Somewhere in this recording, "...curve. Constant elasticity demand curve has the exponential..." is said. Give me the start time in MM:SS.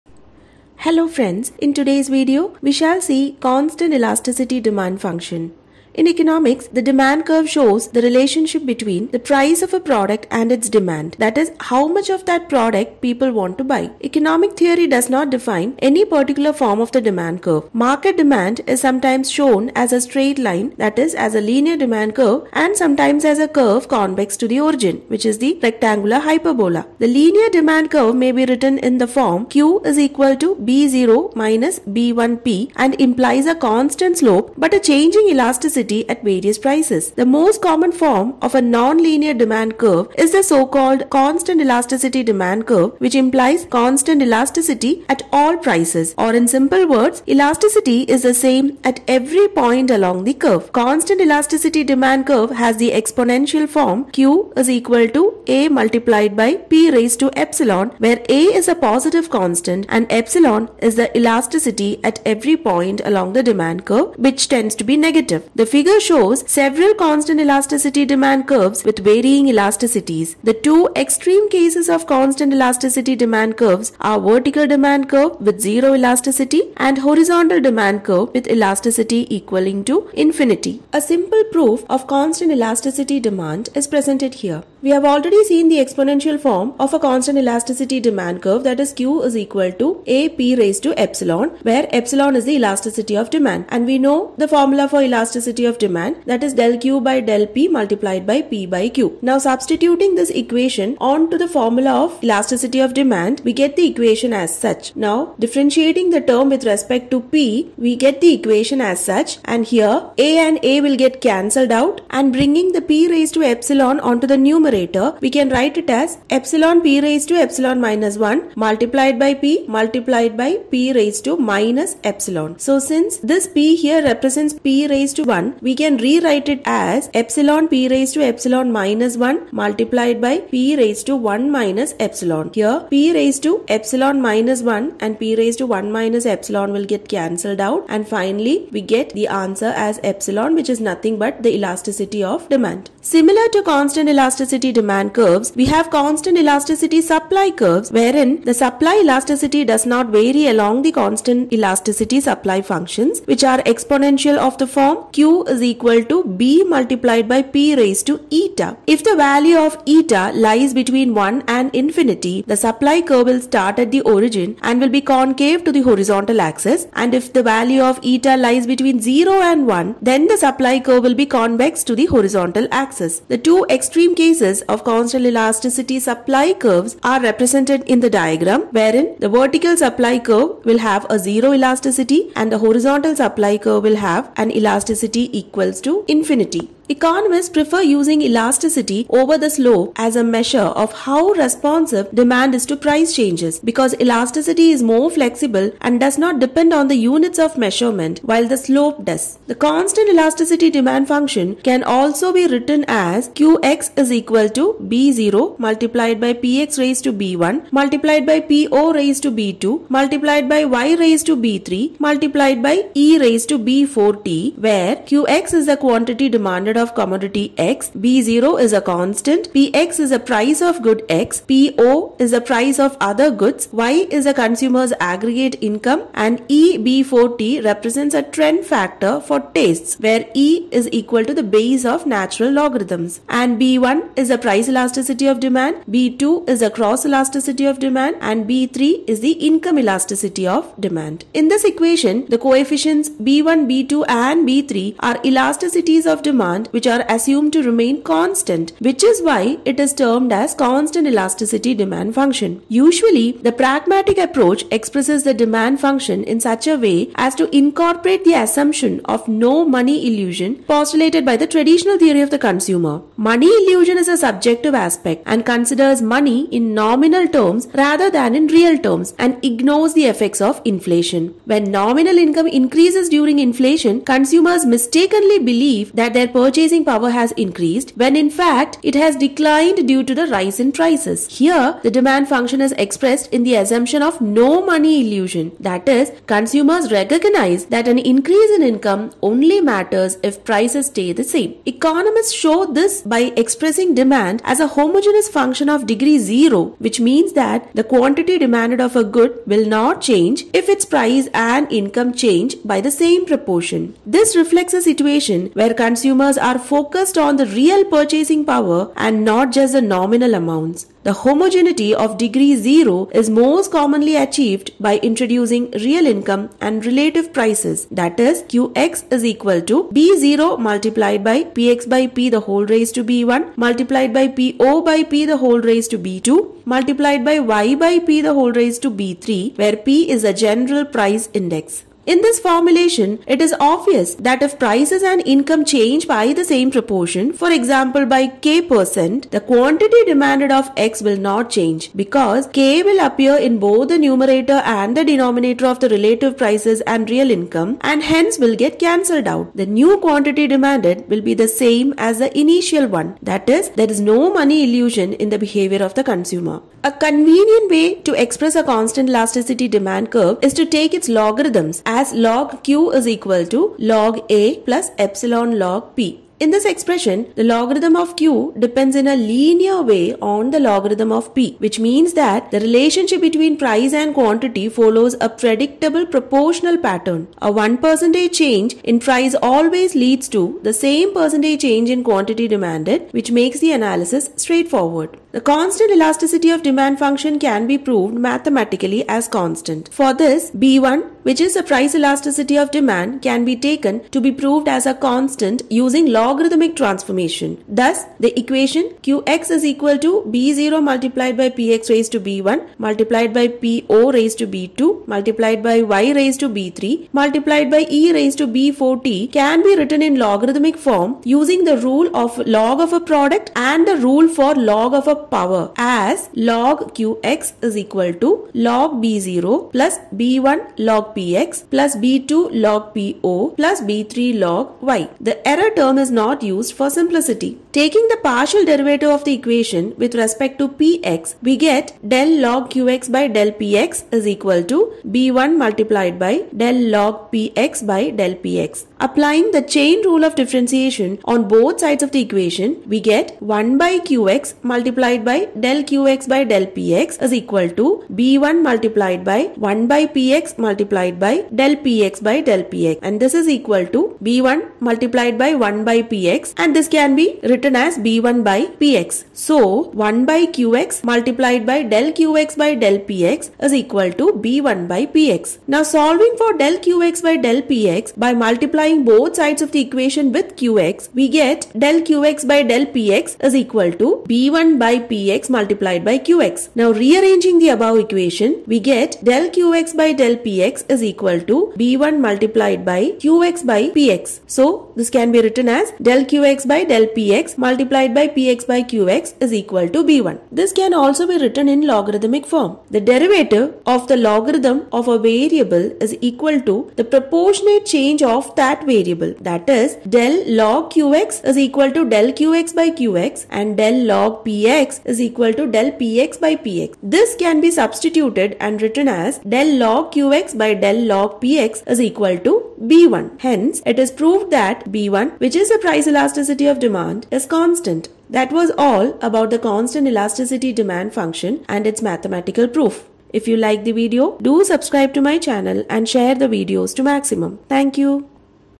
00:50.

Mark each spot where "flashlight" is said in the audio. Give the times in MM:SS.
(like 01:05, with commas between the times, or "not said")
not said.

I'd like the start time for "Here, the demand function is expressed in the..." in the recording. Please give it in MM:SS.
04:41.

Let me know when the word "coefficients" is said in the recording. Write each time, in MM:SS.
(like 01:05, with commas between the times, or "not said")
04:02.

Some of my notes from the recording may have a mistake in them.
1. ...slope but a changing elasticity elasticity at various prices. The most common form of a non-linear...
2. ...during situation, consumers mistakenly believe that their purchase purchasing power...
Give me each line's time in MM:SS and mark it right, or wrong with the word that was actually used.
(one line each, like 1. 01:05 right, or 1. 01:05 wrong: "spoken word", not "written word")
1. 00:34 right
2. 04:33 wrong: "inflation", not "situation".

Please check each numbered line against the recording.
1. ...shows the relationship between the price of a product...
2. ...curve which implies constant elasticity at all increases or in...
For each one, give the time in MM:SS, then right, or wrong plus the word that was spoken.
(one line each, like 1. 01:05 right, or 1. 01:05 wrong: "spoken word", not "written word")
1. 00:07 right
2. 00:42 wrong: "prices", not "increases".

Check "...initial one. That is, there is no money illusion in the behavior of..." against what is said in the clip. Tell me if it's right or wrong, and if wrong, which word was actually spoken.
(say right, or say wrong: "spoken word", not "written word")
right.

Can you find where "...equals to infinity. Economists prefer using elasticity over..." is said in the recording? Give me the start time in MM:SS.
03:05.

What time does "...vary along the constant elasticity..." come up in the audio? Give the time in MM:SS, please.
02:30.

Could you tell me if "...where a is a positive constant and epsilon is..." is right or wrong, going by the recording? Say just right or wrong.
right.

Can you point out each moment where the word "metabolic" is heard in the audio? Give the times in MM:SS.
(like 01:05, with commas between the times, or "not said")
not said.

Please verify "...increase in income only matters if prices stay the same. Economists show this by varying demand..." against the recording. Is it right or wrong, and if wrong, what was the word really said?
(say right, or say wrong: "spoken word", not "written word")
wrong: "expressing", not "varying".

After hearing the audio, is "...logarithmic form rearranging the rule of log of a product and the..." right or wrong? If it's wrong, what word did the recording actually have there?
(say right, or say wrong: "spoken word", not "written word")
wrong: "using", not "rearranging".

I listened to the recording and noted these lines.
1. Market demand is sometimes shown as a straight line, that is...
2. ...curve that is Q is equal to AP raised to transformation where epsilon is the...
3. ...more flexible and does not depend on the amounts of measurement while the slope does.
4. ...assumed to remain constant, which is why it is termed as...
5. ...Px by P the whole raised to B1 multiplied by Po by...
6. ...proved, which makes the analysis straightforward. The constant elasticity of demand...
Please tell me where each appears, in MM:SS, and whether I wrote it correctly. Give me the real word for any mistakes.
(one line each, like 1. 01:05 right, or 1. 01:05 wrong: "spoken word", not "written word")
1. 00:17 right
2. 01:28 wrong: "epsilon", not "transformation"
3. 03:14 wrong: "units", not "amounts"
4. 04:07 right
5. 05:21 right
6. 06:22 wrong: "demanded", not "proved".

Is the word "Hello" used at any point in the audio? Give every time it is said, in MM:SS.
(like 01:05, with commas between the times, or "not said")
00:00.